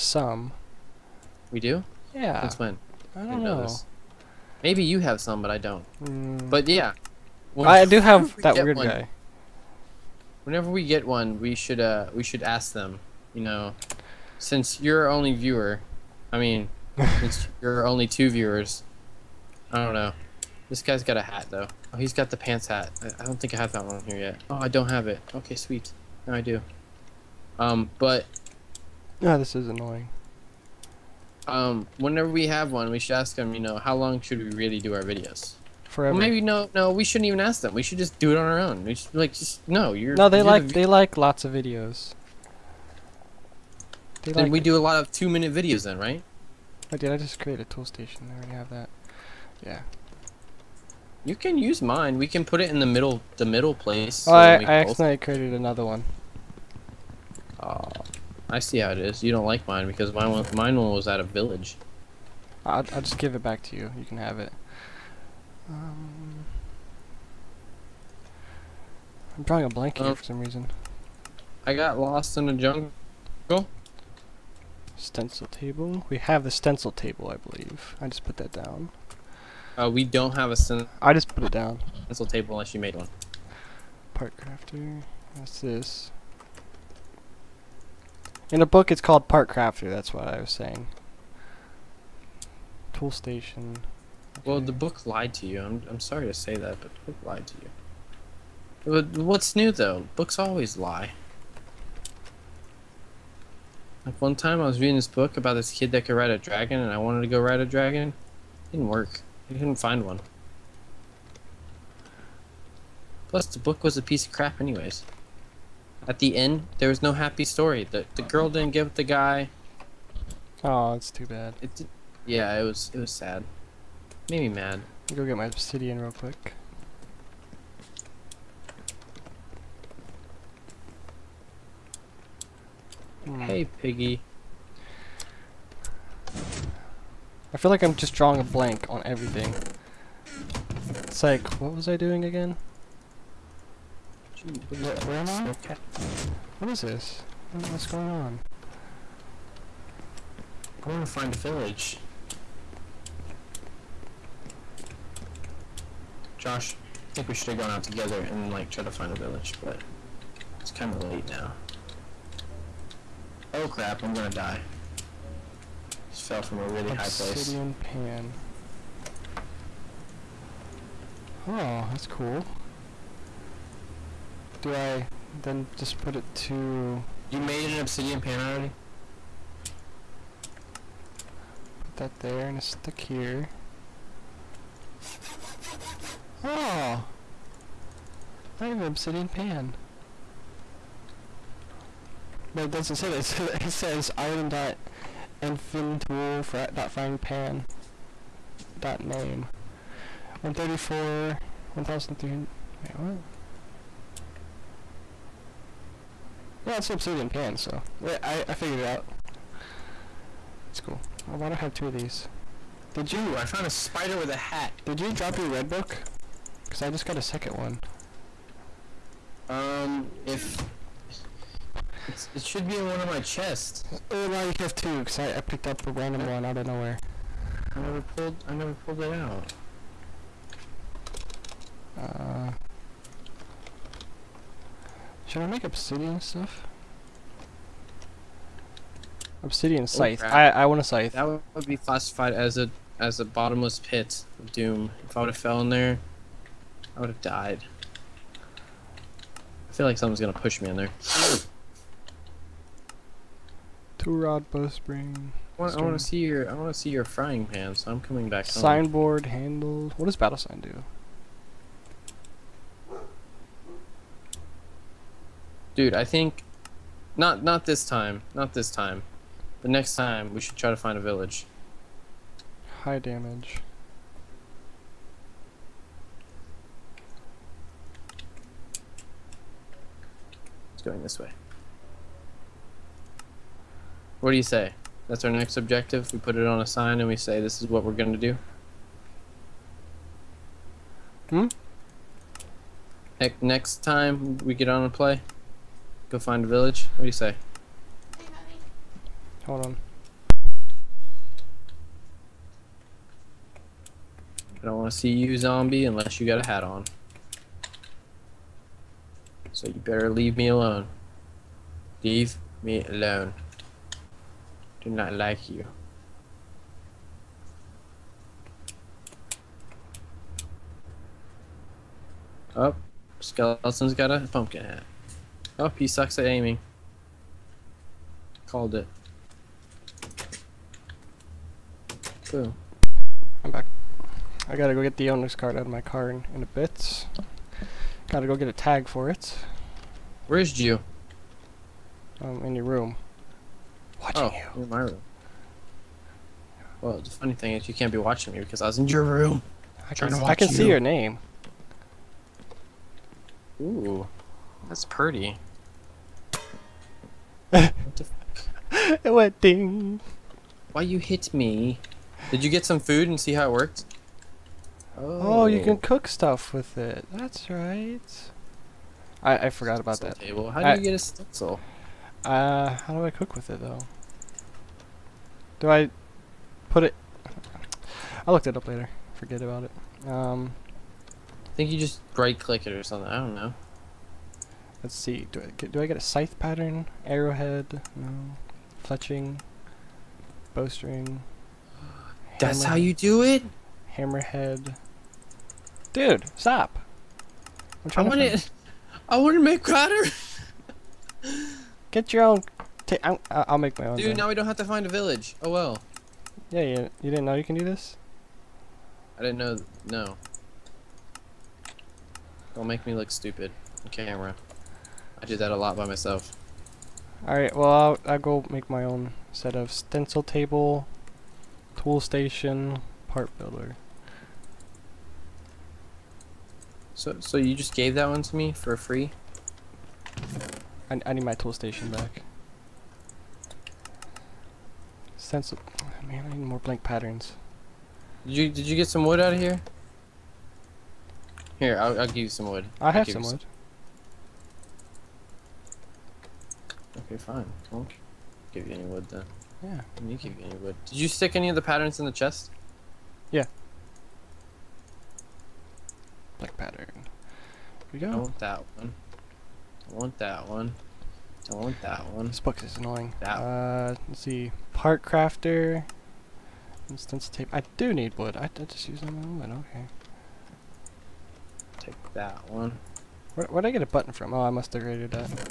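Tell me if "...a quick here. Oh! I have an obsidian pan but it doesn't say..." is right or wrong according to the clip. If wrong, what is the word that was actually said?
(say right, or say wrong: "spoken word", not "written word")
wrong: "stick", not "quick".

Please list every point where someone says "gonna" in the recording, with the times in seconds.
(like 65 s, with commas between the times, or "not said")
164 s, 250 s.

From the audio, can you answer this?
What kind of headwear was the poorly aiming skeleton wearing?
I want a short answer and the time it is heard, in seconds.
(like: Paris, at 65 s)
Pumpkin hat, at 324 s.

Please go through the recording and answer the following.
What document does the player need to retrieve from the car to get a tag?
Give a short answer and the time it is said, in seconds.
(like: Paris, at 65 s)
Owner's card, at 335 s.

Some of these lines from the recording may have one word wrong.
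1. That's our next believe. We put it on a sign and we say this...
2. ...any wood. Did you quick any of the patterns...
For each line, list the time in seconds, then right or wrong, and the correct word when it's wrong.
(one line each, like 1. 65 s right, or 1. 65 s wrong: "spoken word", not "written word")
1. 285 s wrong: "objective", not "believe"
2. 450 s wrong: "stick", not "quick".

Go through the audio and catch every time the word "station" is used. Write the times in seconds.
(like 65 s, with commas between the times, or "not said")
47 s, 93 s, 421 s, 431 s.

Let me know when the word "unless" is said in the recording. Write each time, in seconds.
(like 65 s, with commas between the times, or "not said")
82 s, 305 s.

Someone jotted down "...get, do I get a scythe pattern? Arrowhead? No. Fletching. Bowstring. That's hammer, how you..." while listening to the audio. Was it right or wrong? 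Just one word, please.
right.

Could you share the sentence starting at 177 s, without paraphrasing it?
You made an obsidian pan already?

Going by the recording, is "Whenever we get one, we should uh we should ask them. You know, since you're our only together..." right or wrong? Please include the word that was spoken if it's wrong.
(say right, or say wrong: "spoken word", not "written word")
wrong: "viewer", not "together".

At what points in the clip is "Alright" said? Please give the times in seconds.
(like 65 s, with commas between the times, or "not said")
417 s.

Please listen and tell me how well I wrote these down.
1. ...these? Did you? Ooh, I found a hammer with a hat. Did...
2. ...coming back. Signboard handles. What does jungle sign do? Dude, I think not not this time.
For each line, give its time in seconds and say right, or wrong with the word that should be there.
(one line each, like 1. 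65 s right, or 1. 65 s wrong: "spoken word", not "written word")
1. 211 s wrong: "spider", not "hammer"
2. 257 s wrong: "battle", not "jungle".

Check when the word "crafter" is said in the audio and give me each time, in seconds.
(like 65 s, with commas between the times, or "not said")
84 s, 89 s, 465 s.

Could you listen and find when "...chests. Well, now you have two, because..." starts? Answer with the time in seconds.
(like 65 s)
223 s.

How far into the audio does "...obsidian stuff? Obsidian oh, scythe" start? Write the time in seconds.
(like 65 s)
235 s.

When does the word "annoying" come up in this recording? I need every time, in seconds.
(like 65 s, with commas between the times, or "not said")
29 s, 462 s.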